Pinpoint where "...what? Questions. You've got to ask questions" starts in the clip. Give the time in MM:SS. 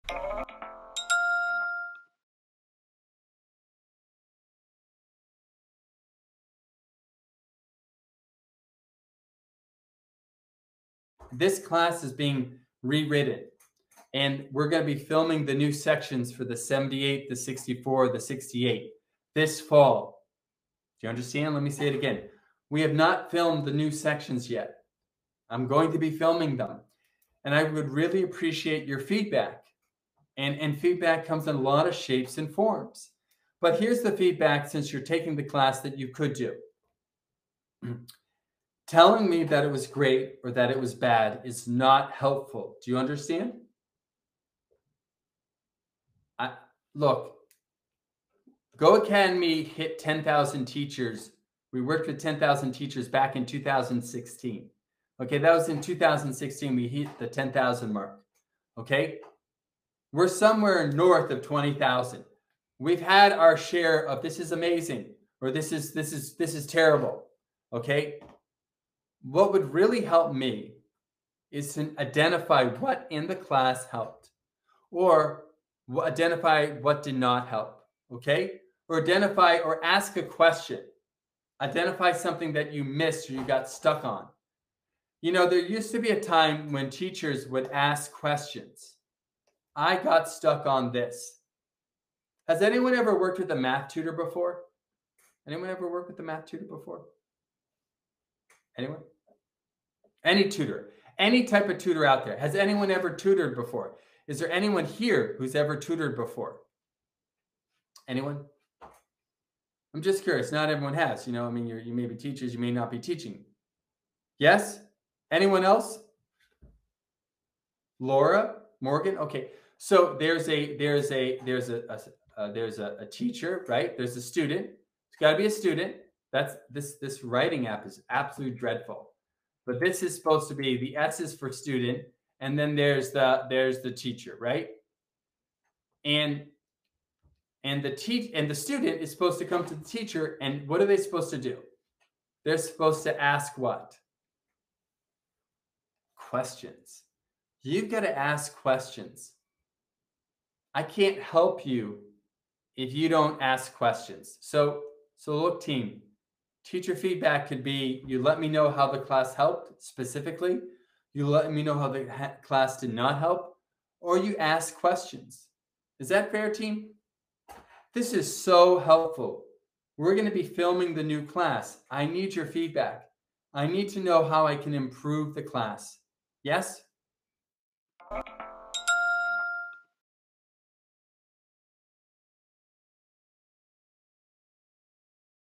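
02:23.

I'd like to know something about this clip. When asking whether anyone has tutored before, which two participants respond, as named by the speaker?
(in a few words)
Laura, Morgan.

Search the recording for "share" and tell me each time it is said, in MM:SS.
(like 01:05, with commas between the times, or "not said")
01:03.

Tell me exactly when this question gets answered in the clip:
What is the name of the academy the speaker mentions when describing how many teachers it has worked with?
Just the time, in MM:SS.
00:48.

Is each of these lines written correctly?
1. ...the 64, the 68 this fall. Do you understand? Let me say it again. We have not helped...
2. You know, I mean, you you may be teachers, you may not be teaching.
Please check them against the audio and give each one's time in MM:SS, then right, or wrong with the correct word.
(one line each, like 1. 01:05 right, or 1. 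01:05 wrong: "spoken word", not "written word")
1. 00:17 wrong: "filmed", not "helped"
2. 01:51 right.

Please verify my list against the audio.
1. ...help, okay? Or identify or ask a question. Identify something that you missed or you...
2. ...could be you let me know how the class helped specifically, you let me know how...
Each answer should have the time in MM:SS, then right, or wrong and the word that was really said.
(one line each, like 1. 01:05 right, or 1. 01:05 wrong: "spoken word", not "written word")
1. 01:17 right
2. 02:37 right.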